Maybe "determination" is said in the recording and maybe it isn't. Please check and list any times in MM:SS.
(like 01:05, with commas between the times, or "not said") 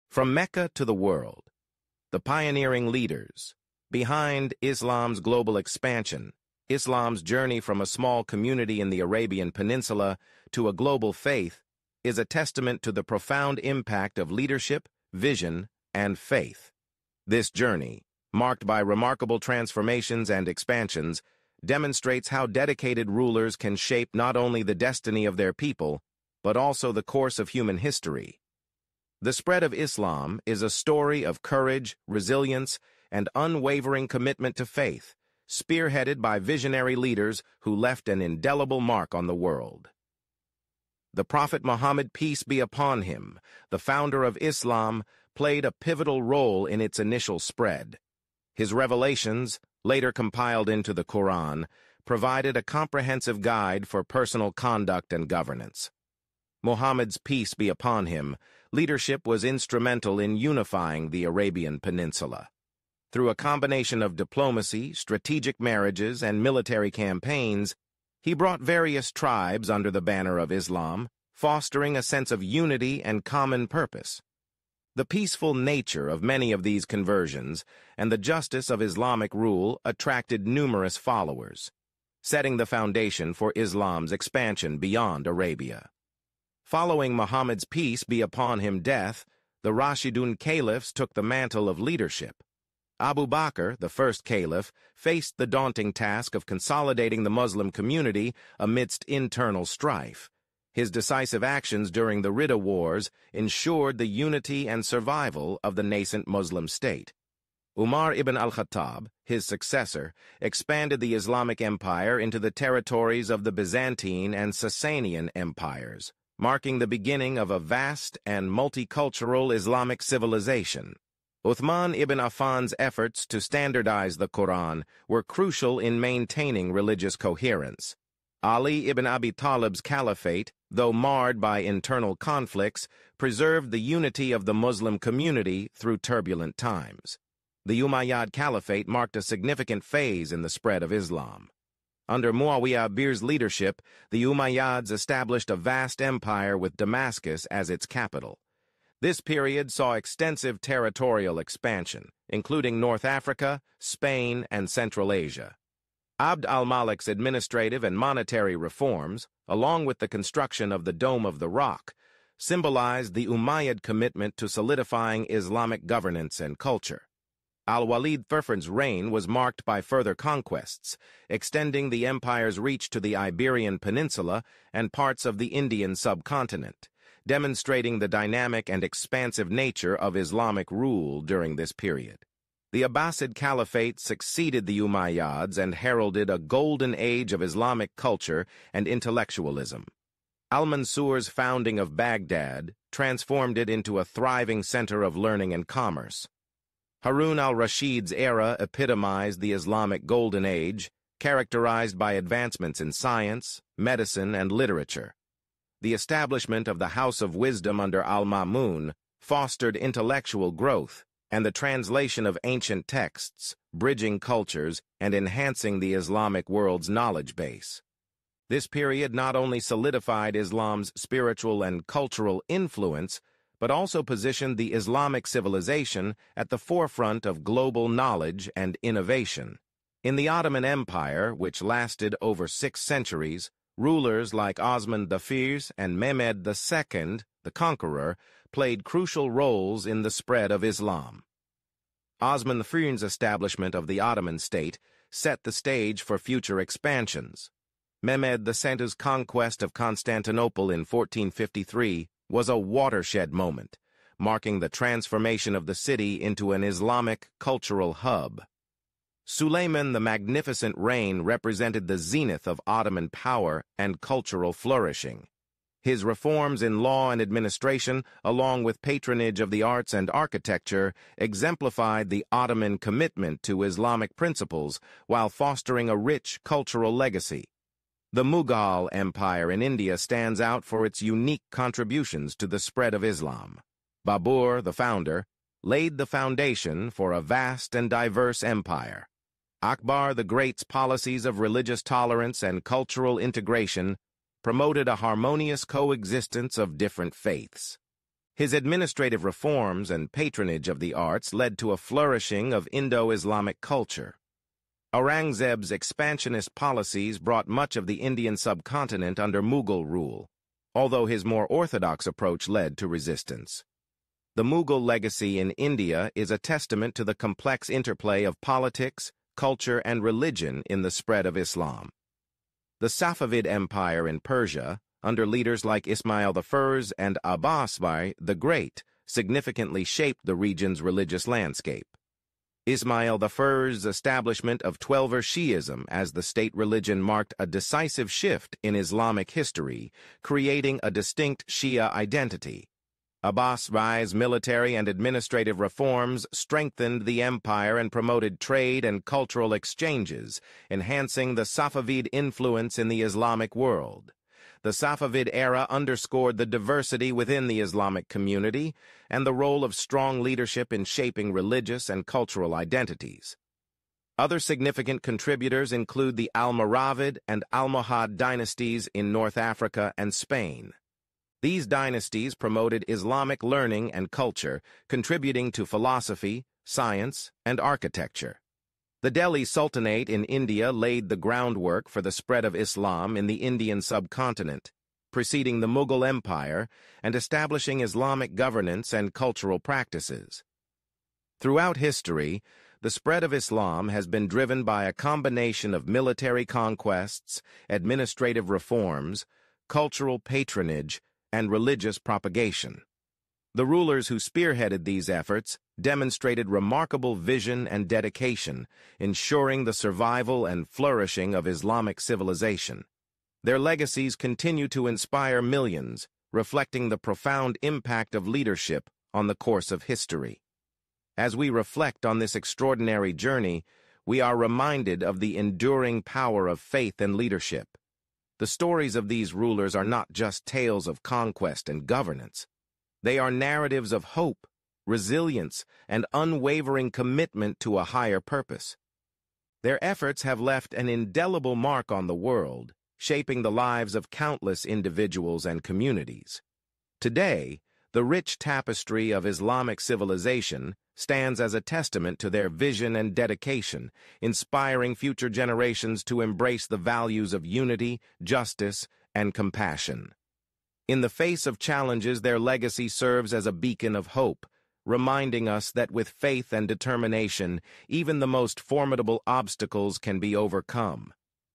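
07:46.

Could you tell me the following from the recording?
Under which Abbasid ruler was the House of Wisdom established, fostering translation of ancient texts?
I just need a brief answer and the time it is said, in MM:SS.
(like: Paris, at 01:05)
al-Ma'mun, at 03:28.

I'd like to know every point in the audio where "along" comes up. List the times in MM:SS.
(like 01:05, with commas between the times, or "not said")
02:39, 04:28.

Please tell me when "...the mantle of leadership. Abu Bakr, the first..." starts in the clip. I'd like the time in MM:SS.
01:31.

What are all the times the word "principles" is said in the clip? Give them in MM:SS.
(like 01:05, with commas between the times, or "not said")
04:34.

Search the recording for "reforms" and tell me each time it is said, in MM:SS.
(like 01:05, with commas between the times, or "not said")
02:38, 04:26, 04:59, 05:45, 06:38.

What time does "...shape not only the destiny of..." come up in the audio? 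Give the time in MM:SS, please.
00:23.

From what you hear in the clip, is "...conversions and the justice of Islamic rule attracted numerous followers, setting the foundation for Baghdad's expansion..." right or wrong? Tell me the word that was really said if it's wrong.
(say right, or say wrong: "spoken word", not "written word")
wrong: "Islam", not "Baghdad".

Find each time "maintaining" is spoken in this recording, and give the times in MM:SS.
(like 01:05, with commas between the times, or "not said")
02:05.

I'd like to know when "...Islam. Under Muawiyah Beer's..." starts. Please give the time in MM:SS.
02:20.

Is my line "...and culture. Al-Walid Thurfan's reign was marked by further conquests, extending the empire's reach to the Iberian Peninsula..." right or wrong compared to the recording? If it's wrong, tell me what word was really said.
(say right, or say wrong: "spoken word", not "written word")
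right.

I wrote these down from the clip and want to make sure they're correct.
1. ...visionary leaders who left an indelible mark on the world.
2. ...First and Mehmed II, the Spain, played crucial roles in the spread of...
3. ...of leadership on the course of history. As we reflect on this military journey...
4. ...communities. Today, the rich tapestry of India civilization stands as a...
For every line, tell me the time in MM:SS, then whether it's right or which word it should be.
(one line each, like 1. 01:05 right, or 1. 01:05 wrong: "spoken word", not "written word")
1. 00:36 right
2. 03:55 wrong: "Conqueror", not "Spain"
3. 06:58 wrong: "extraordinary", not "military"
4. 07:25 wrong: "Islamic", not "India".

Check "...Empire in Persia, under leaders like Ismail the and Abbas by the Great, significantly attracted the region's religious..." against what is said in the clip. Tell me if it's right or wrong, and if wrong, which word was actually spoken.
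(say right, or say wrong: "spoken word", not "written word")
wrong: "shaped", not "attracted".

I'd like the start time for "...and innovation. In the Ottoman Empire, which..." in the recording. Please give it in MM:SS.
03:48.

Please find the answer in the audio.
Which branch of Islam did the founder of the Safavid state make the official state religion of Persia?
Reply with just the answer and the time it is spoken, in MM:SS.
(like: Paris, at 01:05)
Twelver Shi'ism, at 05:34.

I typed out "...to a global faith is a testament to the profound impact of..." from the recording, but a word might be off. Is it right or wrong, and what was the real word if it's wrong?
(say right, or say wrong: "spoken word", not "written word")
right.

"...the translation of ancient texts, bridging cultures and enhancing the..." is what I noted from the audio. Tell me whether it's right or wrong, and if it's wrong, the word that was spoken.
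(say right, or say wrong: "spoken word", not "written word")
right.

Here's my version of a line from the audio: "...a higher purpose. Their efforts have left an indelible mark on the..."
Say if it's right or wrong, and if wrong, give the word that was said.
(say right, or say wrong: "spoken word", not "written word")
right.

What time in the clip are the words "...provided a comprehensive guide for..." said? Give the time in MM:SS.
00:52.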